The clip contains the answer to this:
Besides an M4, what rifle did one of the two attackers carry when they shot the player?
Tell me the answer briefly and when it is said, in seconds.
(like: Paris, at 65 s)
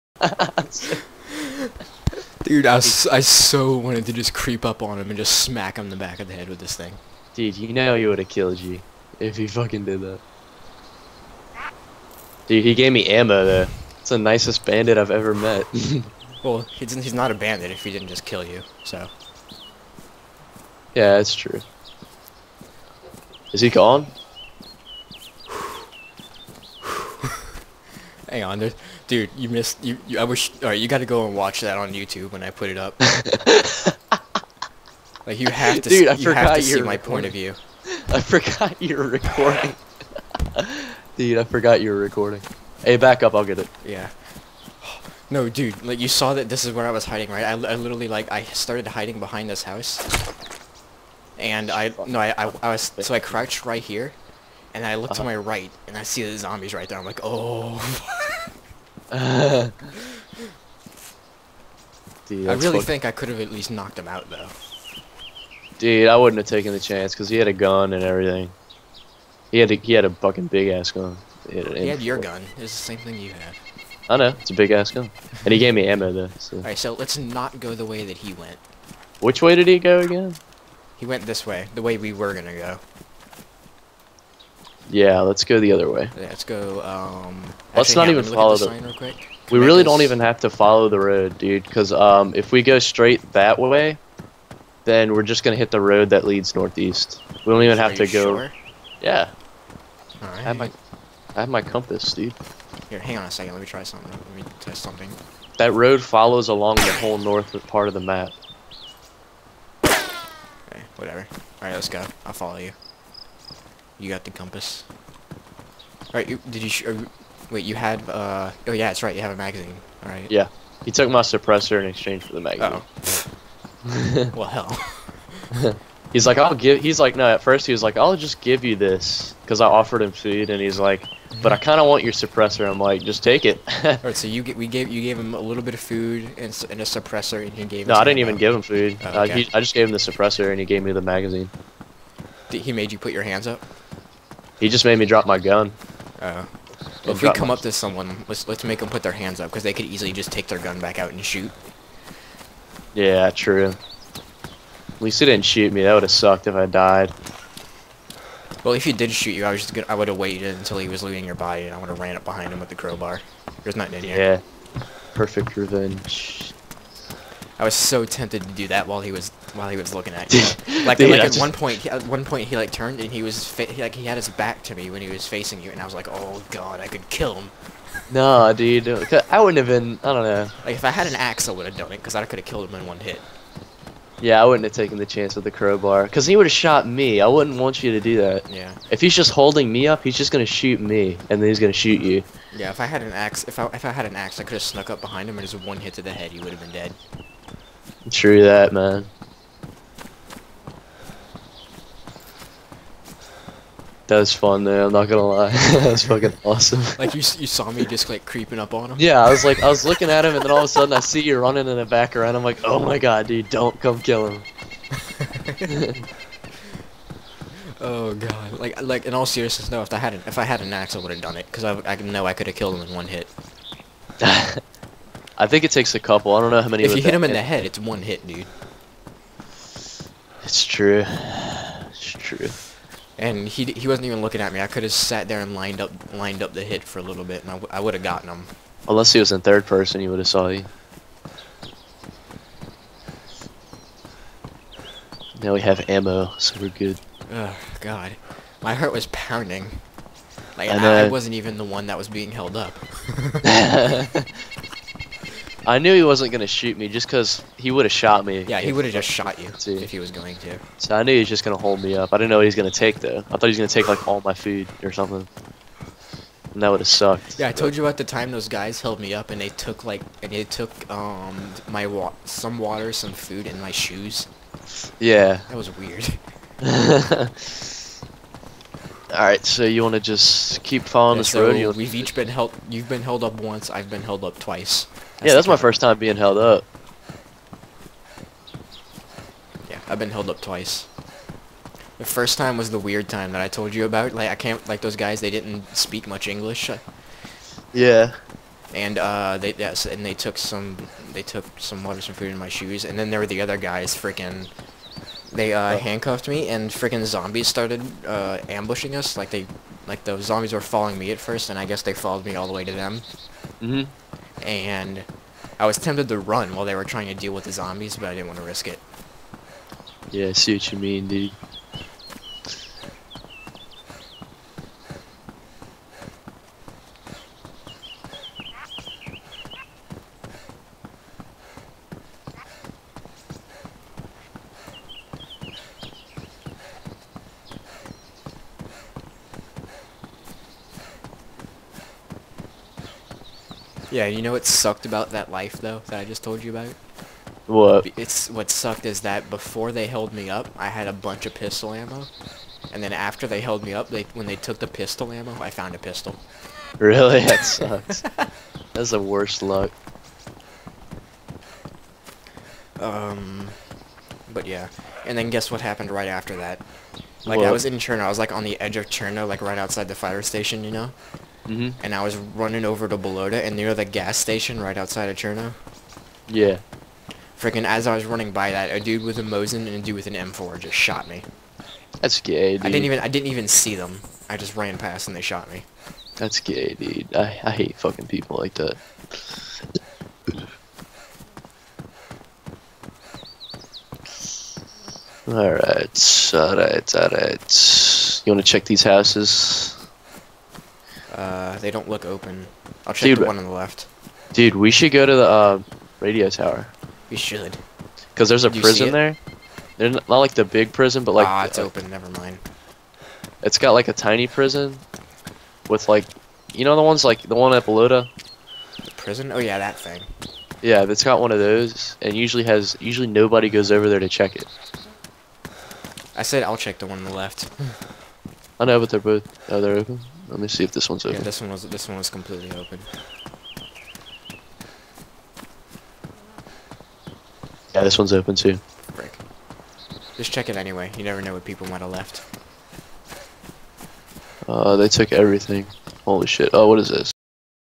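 Mosin, at 378 s.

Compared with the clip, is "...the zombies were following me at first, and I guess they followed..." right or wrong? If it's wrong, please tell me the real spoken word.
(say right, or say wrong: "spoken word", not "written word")
right.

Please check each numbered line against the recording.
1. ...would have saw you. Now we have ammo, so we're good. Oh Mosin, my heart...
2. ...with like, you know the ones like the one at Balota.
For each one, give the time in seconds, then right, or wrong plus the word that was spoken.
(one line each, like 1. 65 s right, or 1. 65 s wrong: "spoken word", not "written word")
1. 240 s wrong: "God", not "Mosin"
2. 415 s right.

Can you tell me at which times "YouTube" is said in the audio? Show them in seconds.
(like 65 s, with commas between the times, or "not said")
31 s.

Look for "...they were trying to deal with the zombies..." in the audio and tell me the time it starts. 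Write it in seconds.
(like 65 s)
316 s.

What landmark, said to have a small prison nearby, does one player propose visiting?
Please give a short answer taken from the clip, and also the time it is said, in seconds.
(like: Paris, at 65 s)
Radio tower, at 405 s.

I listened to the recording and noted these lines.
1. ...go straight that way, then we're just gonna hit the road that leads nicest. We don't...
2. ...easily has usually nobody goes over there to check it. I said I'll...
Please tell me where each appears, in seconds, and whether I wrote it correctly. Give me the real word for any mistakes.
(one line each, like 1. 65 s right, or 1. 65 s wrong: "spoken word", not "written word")
1. 92 s wrong: "northeast", not "nicest"
2. 422 s wrong: "usually", not "easily".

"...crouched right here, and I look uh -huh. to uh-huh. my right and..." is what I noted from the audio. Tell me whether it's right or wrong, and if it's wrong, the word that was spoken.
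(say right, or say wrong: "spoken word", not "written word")
right.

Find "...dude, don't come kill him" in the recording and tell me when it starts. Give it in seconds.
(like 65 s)
213 s.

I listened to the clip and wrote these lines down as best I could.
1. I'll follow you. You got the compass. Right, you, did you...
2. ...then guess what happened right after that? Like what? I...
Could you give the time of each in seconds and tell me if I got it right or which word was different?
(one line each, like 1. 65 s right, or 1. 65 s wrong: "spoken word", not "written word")
1. 112 s right
2. 365 s right.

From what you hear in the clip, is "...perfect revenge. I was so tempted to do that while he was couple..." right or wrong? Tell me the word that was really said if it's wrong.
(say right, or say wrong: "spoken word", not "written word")
wrong: "while", not "couple".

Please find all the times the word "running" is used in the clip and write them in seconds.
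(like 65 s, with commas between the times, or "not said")
211 s, 372 s, 378 s.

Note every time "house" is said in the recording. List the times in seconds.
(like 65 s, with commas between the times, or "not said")
49 s, 398 s.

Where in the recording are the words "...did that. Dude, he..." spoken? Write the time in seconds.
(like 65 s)
9 s.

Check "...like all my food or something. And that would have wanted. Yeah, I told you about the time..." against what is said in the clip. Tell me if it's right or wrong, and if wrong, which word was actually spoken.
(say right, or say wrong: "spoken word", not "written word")
wrong: "sucked", not "wanted".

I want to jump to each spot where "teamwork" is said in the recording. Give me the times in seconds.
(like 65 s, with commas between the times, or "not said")
not said.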